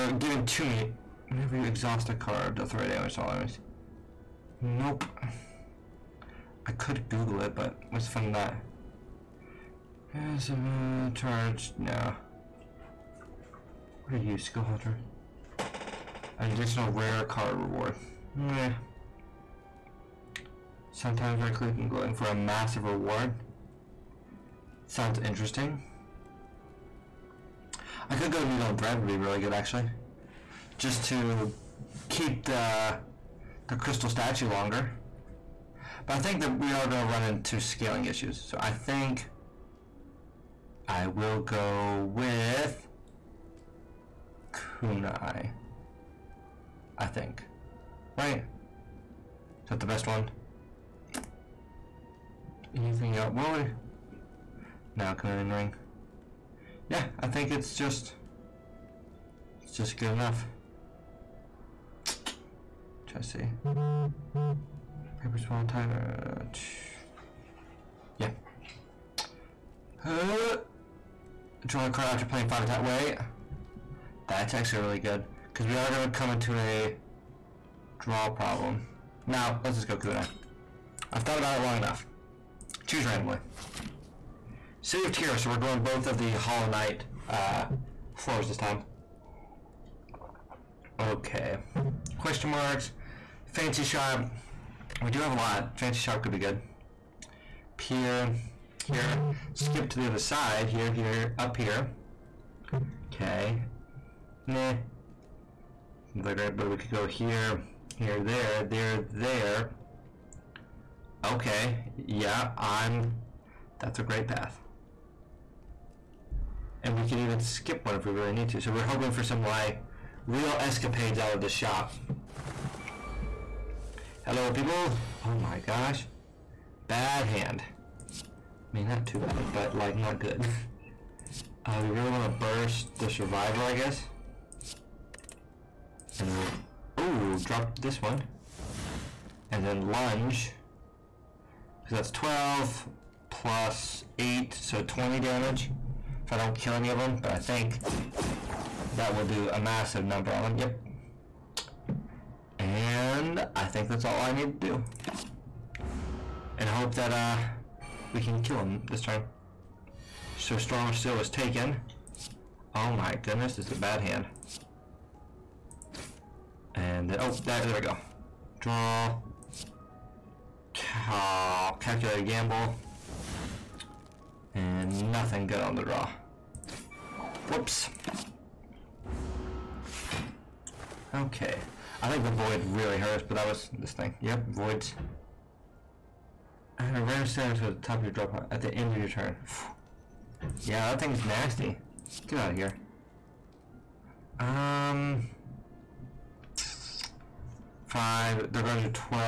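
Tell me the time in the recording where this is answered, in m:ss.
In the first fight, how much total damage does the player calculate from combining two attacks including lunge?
2:24.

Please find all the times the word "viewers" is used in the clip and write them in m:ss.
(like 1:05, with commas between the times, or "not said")
not said.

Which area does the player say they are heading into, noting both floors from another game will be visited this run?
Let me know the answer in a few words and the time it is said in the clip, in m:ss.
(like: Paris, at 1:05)
City of Tears, at 1:24.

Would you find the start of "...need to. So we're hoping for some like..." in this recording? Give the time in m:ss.
1:58.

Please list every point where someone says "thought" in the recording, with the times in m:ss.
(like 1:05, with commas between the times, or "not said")
1:21.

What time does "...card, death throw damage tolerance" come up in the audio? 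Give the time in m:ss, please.
0:02.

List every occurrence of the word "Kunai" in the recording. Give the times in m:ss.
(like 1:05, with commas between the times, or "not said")
0:44, 1:19.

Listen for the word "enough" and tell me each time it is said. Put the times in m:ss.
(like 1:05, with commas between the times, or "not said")
1:00, 1:21.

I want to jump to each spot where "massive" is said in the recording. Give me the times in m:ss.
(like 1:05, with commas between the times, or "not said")
0:22, 2:29.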